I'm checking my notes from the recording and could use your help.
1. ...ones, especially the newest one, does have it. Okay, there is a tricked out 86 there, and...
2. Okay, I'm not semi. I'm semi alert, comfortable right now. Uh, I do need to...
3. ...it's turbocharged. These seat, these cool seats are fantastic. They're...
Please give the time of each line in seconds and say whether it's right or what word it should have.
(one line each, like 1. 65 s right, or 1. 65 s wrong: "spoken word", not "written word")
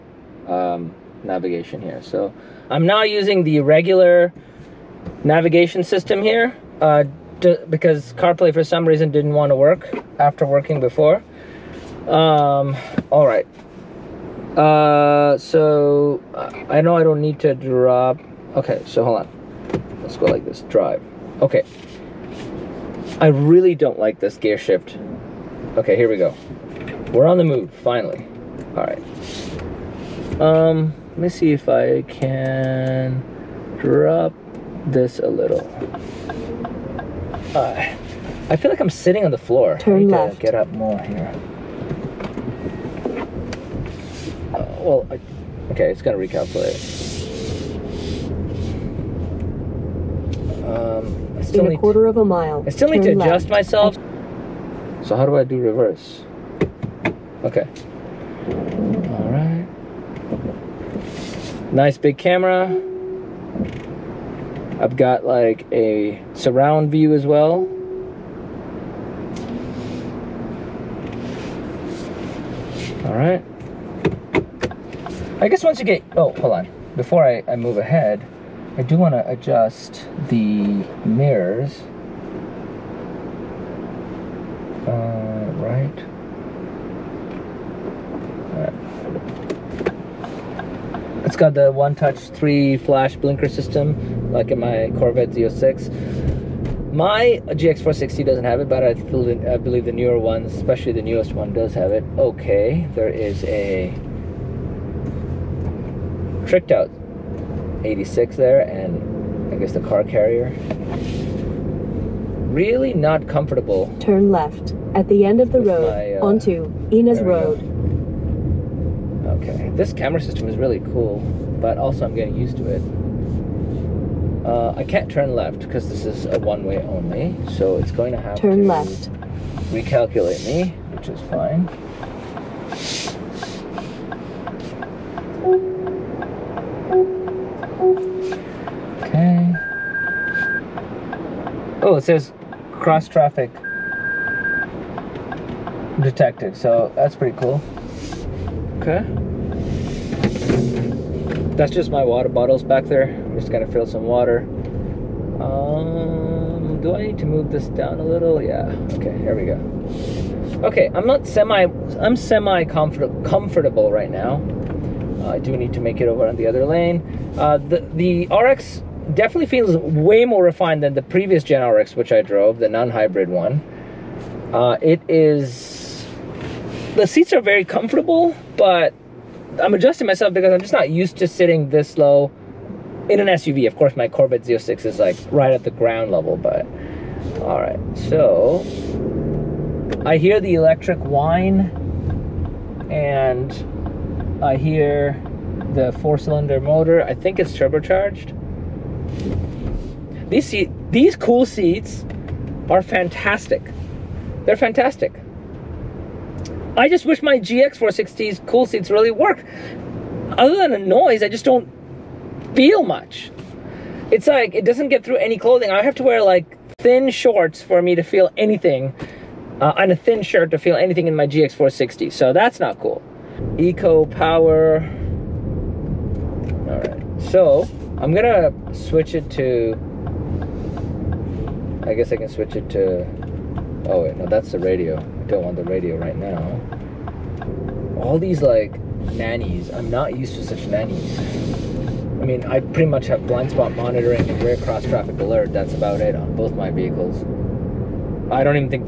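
1. 100 s right
2. 160 s wrong: "comfort", not "alert"
3. 197 s right.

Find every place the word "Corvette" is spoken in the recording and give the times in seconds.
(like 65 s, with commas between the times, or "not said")
94 s, 184 s.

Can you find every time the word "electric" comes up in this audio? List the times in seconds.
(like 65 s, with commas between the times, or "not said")
190 s.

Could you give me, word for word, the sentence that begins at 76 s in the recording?
Before I, I move ahead, I do want to adjust the mirrors.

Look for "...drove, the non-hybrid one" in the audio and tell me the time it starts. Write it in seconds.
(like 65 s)
172 s.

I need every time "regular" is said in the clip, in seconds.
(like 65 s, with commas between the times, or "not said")
3 s.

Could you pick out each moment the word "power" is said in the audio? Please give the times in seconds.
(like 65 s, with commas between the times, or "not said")
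224 s.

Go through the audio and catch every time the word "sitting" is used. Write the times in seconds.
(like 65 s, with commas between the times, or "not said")
38 s, 181 s.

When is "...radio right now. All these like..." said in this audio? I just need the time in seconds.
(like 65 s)
235 s.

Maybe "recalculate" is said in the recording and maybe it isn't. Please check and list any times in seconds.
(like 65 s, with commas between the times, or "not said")
46 s, 129 s.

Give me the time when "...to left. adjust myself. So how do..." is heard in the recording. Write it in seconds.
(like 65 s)
53 s.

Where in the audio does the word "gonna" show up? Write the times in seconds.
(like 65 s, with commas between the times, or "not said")
46 s, 153 s, 228 s.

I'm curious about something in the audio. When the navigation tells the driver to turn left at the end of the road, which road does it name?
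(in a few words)
Ynez Road.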